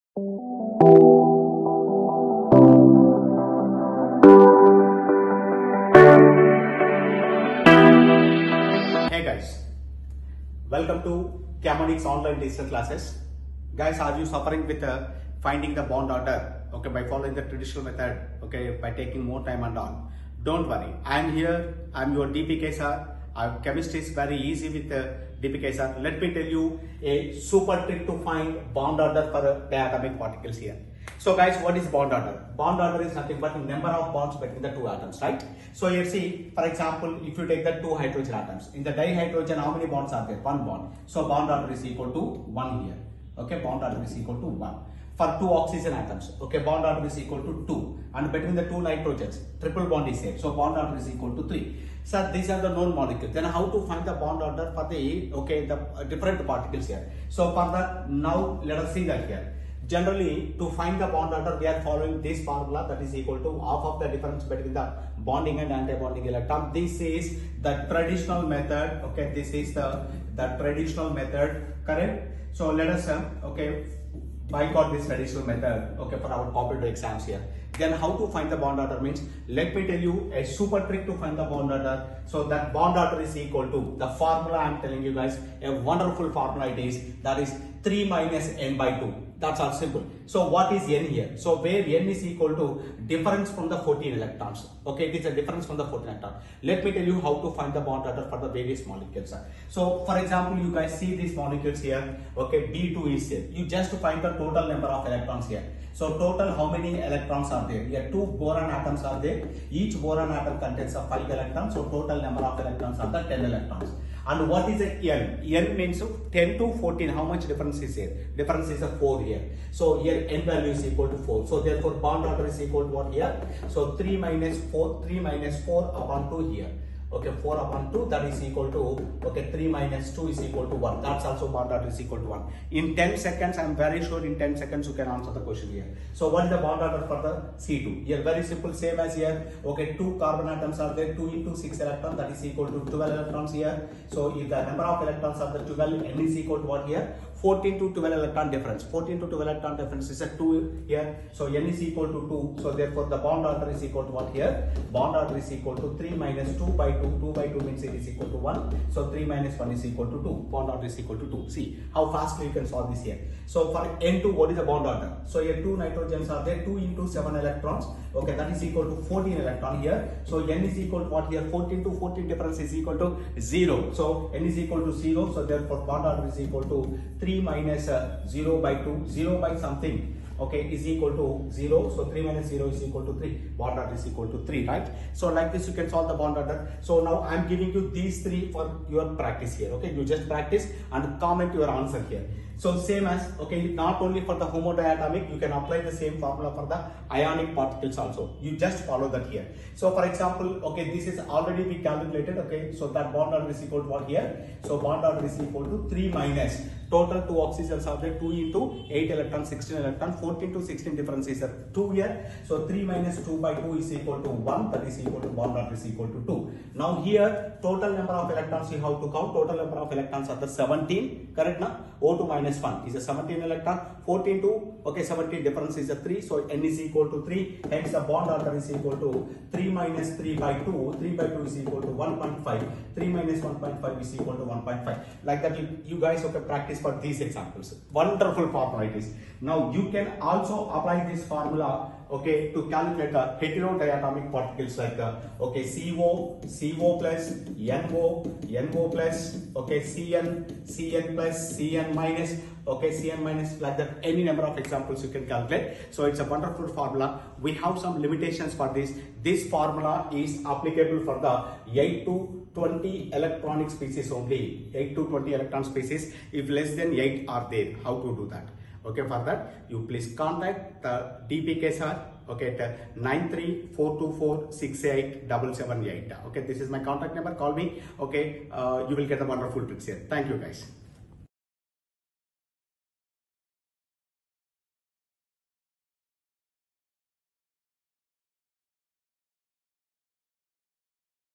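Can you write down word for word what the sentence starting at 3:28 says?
2 into 8 electron, 16 electron, 14 to 16 difference is 2 here.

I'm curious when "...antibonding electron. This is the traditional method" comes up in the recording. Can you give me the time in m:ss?
1:05.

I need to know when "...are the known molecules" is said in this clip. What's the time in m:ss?
0:52.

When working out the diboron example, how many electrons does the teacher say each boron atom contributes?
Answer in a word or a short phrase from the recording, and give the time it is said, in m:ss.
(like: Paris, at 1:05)
5, at 1:51.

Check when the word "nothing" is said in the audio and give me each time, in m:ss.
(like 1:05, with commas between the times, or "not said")
0:33.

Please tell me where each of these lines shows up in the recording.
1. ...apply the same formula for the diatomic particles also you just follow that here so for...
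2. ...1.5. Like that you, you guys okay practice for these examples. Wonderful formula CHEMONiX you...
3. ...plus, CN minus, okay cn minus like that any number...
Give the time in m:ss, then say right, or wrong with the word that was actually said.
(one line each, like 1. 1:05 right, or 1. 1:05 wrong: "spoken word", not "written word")
1. 3:15 wrong: "ionic", not "diatomic"
2. 3:54 wrong: "Now", not "CHEMONiX"
3. 4:11 right.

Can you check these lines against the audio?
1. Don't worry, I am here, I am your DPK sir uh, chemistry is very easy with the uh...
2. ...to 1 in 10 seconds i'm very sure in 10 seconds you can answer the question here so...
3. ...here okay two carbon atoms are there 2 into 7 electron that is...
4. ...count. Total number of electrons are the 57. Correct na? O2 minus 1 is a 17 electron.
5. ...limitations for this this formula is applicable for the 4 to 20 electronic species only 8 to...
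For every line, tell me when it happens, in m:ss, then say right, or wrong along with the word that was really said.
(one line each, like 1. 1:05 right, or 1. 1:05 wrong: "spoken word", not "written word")
1. 0:20 right
2. 2:12 right
3. 2:19 wrong: "6", not "7"
4. 3:39 wrong: "17", not "57"
5. 4:17 wrong: "8", not "4".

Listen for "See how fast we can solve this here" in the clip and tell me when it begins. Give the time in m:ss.
2:41.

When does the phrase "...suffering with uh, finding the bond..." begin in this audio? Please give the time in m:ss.
0:14.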